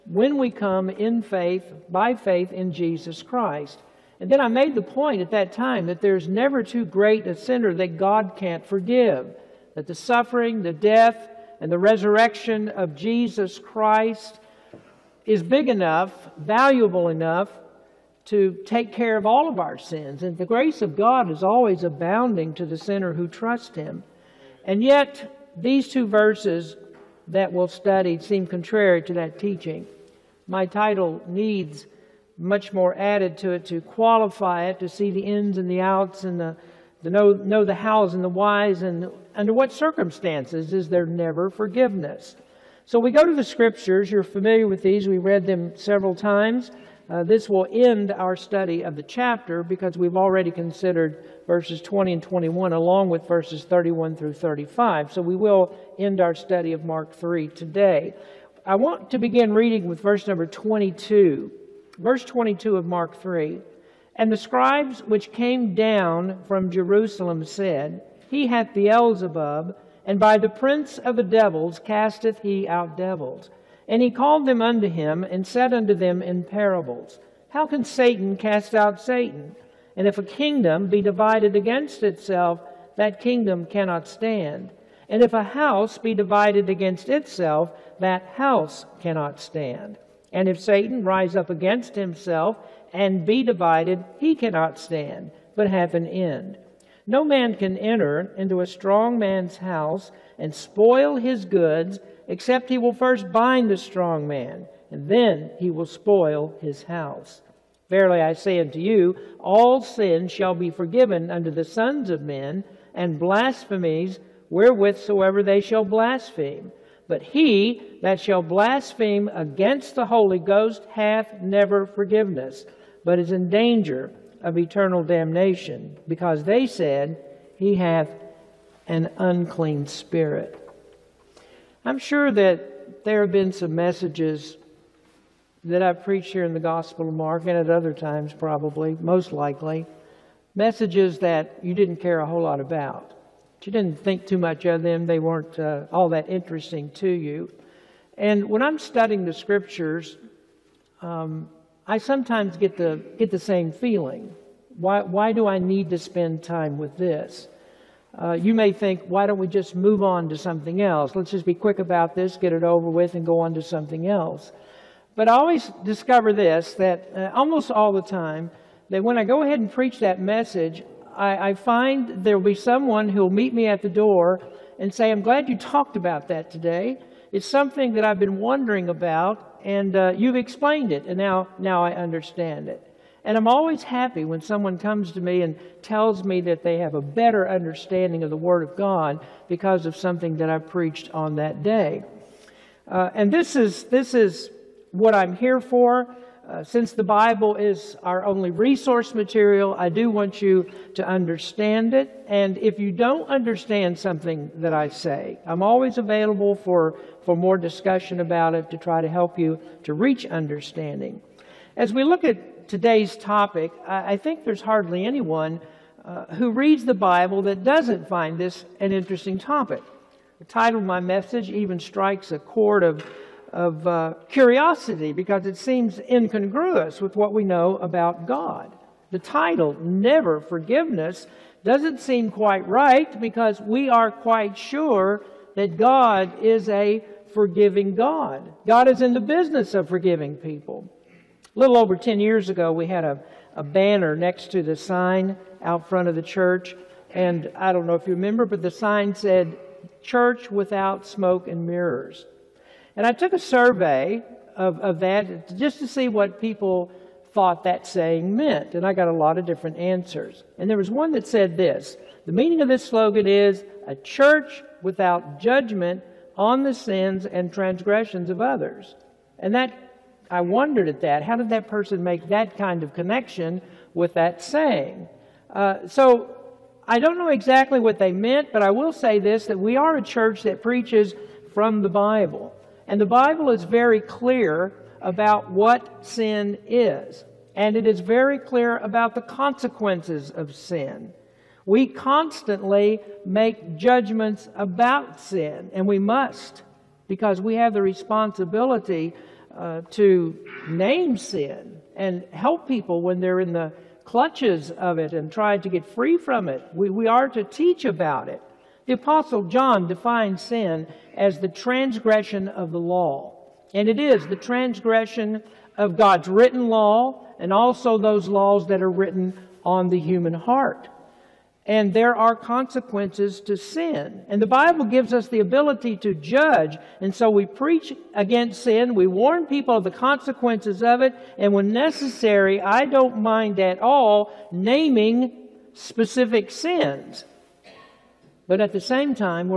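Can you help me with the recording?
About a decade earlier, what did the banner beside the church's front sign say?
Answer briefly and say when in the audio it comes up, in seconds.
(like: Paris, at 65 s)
Church Without Smoke and Mirrors, at 250 s.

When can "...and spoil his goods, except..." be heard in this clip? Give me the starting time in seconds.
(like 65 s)
100 s.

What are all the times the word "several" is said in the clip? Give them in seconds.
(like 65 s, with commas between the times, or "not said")
45 s.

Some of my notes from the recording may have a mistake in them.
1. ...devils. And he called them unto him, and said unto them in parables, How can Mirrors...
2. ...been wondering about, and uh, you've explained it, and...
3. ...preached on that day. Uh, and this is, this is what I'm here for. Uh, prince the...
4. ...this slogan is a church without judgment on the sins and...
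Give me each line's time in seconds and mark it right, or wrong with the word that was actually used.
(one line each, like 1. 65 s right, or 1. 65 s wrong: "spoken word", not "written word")
1. 72 s wrong: "Satan", not "Mirrors"
2. 178 s right
3. 190 s wrong: "since", not "prince"
4. 262 s right.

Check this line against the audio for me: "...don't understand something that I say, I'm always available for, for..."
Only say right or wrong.
right.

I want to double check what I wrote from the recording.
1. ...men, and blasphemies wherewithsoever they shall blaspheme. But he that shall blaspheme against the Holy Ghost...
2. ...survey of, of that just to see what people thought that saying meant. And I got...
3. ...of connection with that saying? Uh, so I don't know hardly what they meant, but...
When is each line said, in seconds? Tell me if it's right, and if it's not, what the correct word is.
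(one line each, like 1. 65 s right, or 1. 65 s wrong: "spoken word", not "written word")
1. 112 s right
2. 253 s right
3. 272 s wrong: "exactly", not "hardly".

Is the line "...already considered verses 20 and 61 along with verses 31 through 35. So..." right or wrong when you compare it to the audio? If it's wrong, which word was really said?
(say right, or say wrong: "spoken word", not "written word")
wrong: "21", not "61".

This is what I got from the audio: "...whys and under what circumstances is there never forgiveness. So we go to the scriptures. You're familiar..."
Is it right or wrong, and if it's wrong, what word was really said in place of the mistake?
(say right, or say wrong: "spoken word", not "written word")
right.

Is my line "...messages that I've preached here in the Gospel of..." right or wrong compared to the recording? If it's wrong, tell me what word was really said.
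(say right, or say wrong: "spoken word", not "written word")
right.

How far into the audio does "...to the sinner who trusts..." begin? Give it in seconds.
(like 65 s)
22 s.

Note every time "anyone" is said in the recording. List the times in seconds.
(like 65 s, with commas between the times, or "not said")
215 s.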